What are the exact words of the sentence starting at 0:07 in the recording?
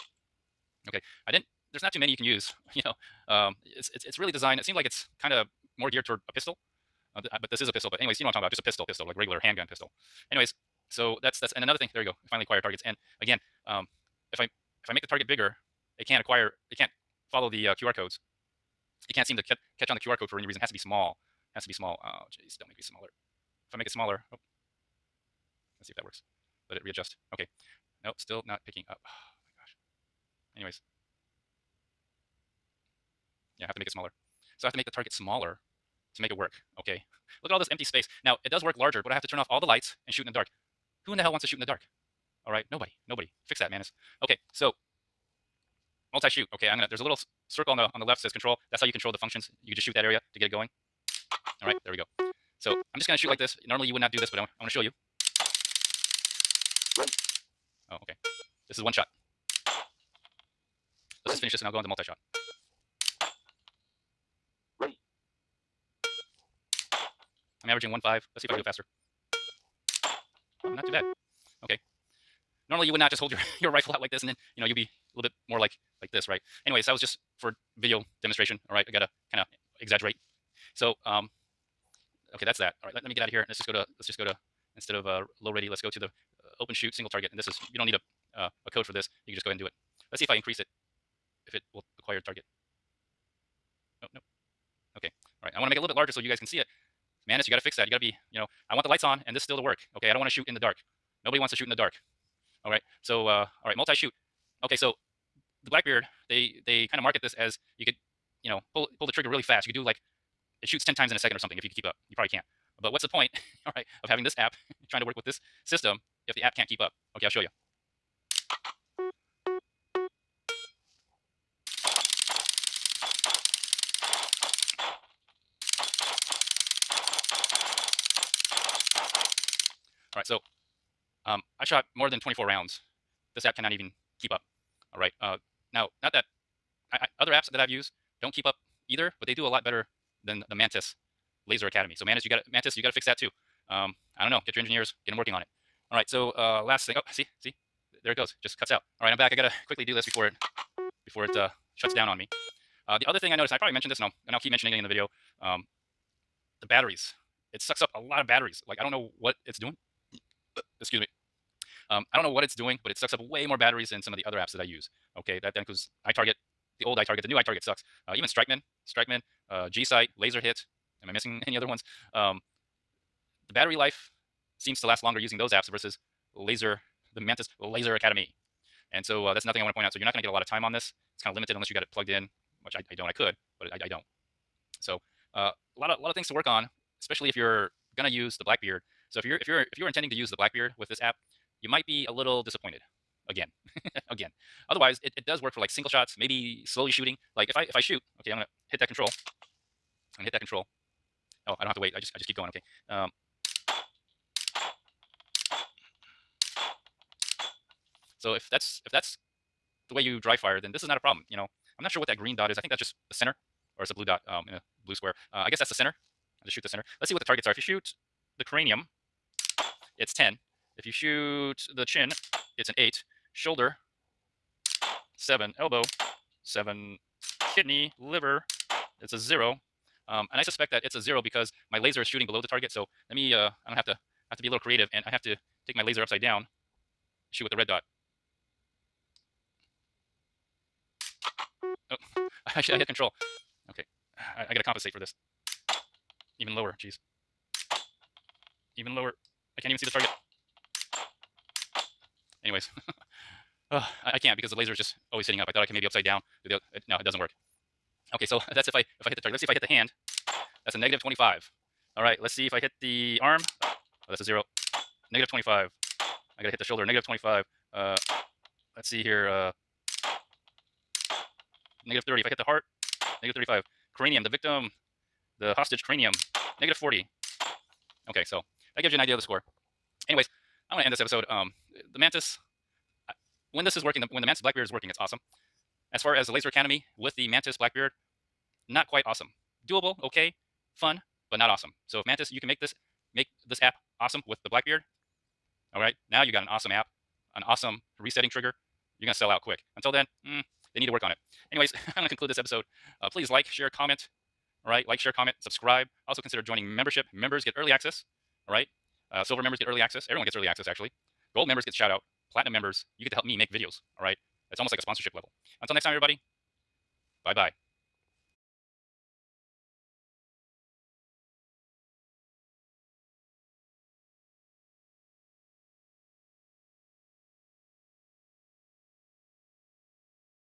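But anyways, you know what I'm talking about.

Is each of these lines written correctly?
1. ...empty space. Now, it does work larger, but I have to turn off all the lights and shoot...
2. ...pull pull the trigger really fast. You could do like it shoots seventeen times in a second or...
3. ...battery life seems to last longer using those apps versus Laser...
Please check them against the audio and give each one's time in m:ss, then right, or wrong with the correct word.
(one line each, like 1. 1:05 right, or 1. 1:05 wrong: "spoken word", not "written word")
1. 0:37 right
2. 1:48 wrong: "ten", not "seventeen"
3. 2:53 right.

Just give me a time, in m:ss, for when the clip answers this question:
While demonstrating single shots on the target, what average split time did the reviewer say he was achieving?
1:07.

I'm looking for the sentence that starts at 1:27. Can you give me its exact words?
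And this is you don't need a uh, a code for this you can just go ahead and do it.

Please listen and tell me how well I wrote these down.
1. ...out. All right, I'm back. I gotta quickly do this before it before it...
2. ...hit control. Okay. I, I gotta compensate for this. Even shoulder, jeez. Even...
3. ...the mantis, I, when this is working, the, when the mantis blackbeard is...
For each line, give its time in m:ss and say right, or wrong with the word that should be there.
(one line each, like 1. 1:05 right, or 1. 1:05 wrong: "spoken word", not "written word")
1. 2:28 right
2. 4:02 wrong: "lower", not "shoulder"
3. 4:41 right.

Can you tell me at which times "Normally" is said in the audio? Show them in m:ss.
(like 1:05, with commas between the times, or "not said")
0:53, 1:12.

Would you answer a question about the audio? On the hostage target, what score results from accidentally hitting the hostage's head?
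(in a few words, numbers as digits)
-40.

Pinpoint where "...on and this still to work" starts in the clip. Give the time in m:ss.
1:39.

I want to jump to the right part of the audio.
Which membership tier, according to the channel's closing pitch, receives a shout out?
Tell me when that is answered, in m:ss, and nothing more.
5:11.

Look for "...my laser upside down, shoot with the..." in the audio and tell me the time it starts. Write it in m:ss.
3:55.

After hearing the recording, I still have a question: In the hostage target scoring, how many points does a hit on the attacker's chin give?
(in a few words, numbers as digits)
8.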